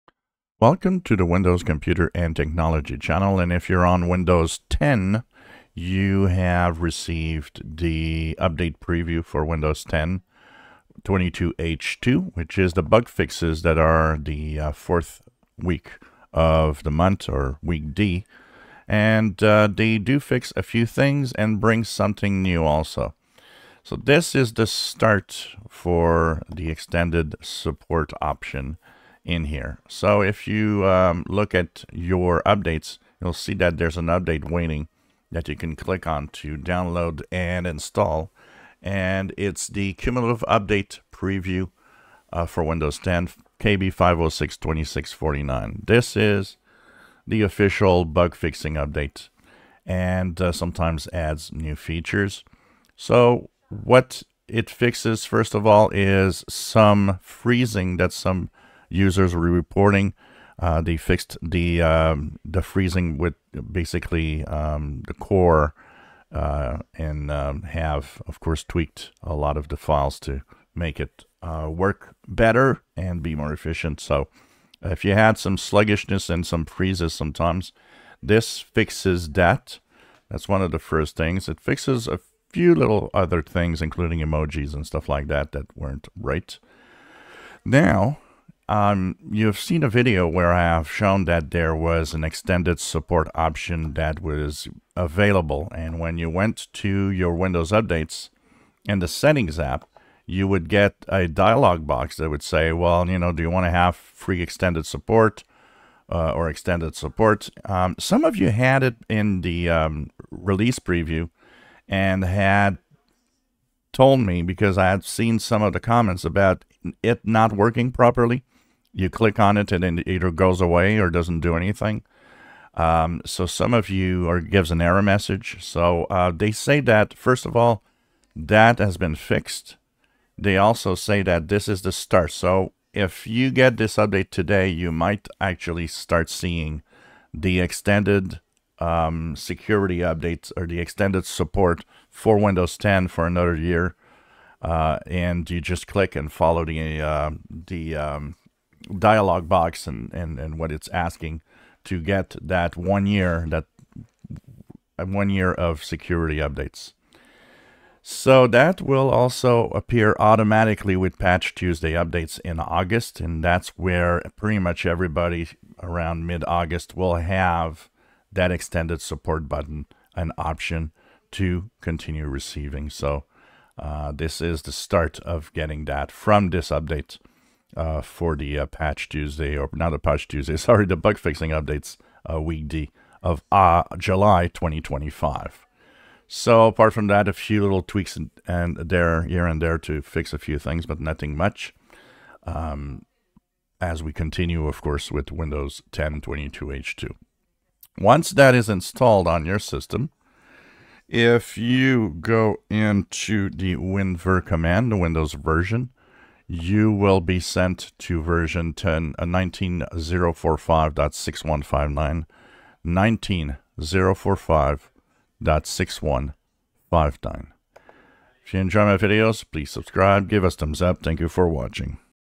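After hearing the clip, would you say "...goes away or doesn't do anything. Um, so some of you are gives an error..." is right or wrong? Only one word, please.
right.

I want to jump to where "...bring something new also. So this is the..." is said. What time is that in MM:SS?
00:21.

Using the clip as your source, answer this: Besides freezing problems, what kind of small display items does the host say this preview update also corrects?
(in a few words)
emojis.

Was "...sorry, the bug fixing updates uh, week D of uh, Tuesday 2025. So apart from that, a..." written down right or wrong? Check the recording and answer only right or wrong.
wrong.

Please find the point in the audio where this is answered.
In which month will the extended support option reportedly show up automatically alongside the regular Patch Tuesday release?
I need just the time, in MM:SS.
02:42.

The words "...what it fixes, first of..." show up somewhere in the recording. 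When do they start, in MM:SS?
00:53.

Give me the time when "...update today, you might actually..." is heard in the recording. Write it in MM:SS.
02:13.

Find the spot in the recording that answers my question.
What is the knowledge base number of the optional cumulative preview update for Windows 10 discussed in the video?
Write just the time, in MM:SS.
00:43.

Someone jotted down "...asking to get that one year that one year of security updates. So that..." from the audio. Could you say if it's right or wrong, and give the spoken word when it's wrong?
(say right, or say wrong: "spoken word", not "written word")
right.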